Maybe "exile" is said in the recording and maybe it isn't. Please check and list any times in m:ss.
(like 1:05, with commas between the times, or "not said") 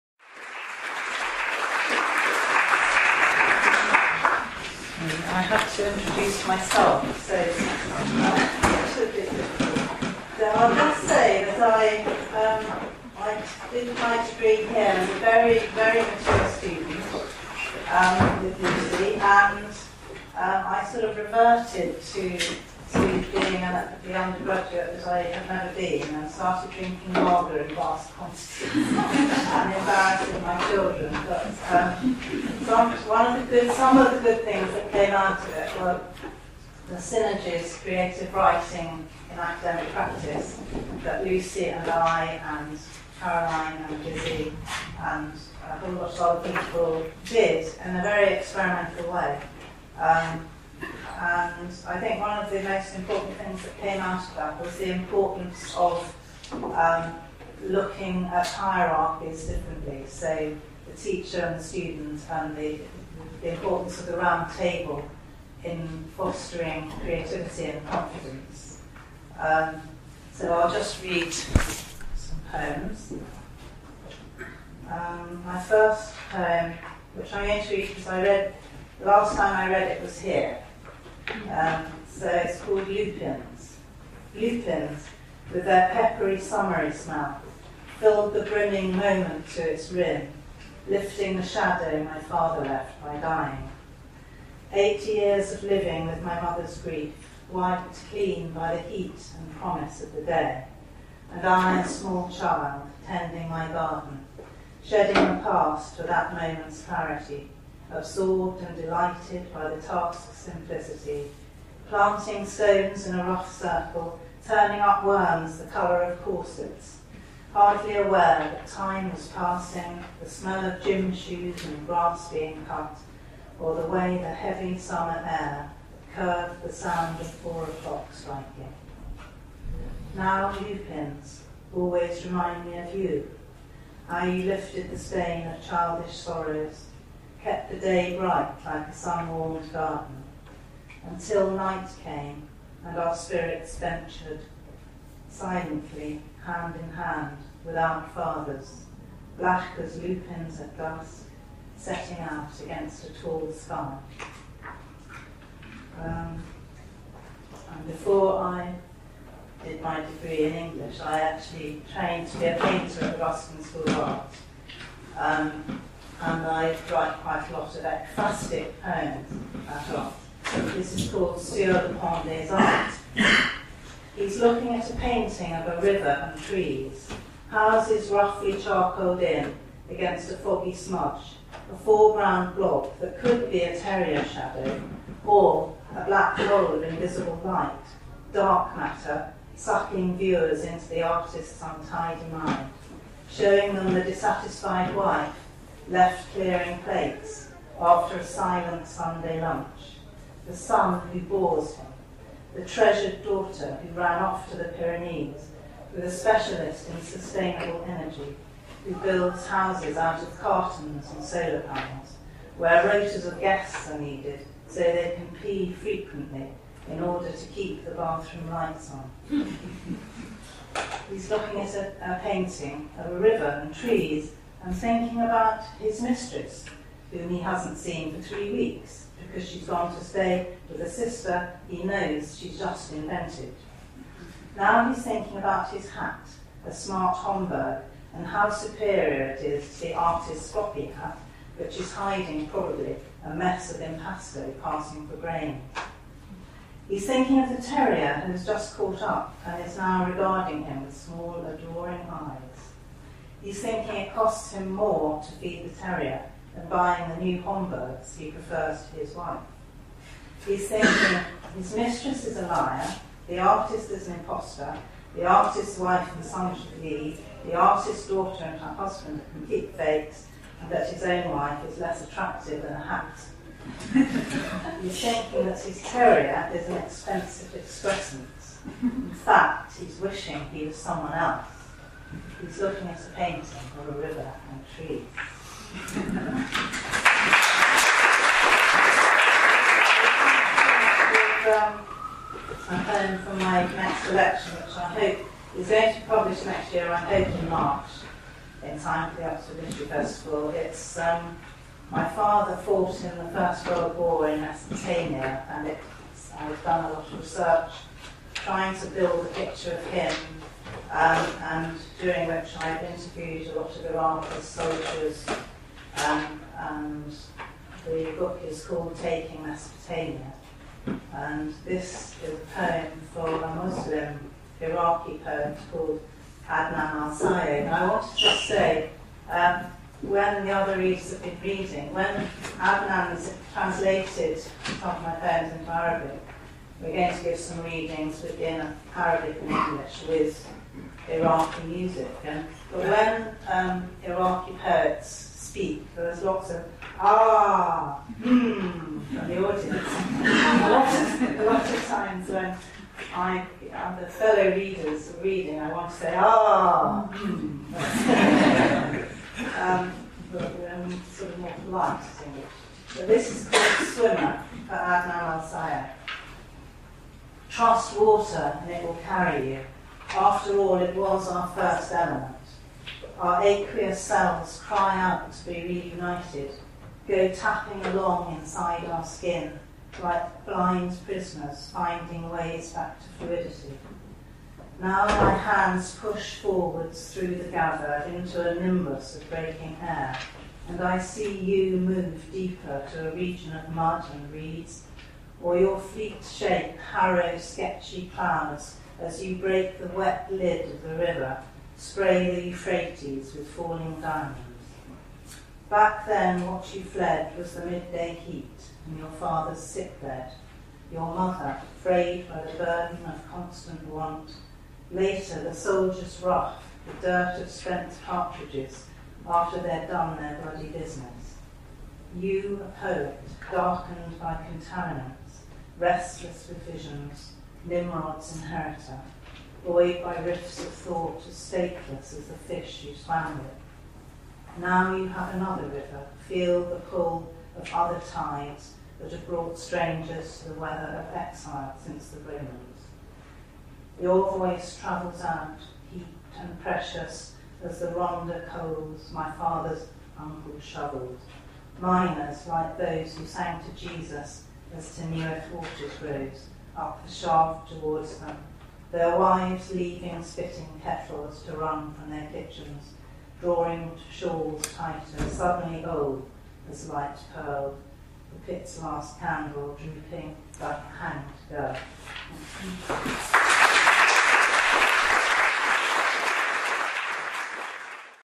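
7:21.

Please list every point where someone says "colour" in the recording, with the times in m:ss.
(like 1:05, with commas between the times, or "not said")
1:55.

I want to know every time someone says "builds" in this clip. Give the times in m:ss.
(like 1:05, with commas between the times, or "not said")
3:28, 5:08.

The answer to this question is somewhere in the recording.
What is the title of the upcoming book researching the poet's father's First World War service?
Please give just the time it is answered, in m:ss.
5:19.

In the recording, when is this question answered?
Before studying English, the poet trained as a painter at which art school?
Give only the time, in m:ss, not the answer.
2:43.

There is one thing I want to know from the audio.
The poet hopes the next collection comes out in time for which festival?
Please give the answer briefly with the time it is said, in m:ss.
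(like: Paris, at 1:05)
Oxford Literary Festival, at 4:59.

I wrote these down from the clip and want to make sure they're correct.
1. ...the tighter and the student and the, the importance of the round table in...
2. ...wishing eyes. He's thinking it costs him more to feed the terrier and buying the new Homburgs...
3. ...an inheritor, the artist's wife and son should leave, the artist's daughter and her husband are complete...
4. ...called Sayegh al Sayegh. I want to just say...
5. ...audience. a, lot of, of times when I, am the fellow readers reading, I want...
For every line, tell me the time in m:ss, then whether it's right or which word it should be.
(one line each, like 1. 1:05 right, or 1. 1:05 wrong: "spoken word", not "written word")
1. 1:00 wrong: "teacher", not "tighter"
2. 4:11 wrong: "adoring", not "wishing"
3. 4:24 wrong: "impostor", not "inheritor"
4. 5:25 wrong: "Adnan", not "Sayegh"
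5. 5:49 right.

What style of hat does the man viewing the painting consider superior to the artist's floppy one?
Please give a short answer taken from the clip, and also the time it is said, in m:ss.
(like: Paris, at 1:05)
Homburg, at 3:57.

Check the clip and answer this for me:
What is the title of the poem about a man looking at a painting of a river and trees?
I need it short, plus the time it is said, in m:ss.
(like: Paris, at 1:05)
Sur le Pont des Arts, at 2:51.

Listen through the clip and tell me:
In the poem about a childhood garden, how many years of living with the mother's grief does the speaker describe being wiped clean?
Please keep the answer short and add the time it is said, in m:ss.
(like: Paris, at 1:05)
8, at 1:34.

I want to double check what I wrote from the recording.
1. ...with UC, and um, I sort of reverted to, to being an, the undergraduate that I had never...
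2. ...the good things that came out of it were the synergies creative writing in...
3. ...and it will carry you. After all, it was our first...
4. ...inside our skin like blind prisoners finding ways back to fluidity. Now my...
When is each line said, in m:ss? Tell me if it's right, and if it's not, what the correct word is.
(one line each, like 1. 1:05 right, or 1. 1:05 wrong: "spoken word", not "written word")
1. 0:18 right
2. 0:34 right
3. 6:08 right
4. 6:18 right.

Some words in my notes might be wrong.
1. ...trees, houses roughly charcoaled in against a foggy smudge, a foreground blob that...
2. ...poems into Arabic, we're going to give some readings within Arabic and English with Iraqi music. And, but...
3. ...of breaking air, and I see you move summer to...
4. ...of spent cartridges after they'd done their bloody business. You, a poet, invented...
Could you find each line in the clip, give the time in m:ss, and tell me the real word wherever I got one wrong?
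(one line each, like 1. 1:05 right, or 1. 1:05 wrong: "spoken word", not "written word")
1. 2:56 right
2. 5:35 right
3. 6:29 wrong: "deeper", not "summer"
4. 6:57 wrong: "darkened", not "invented".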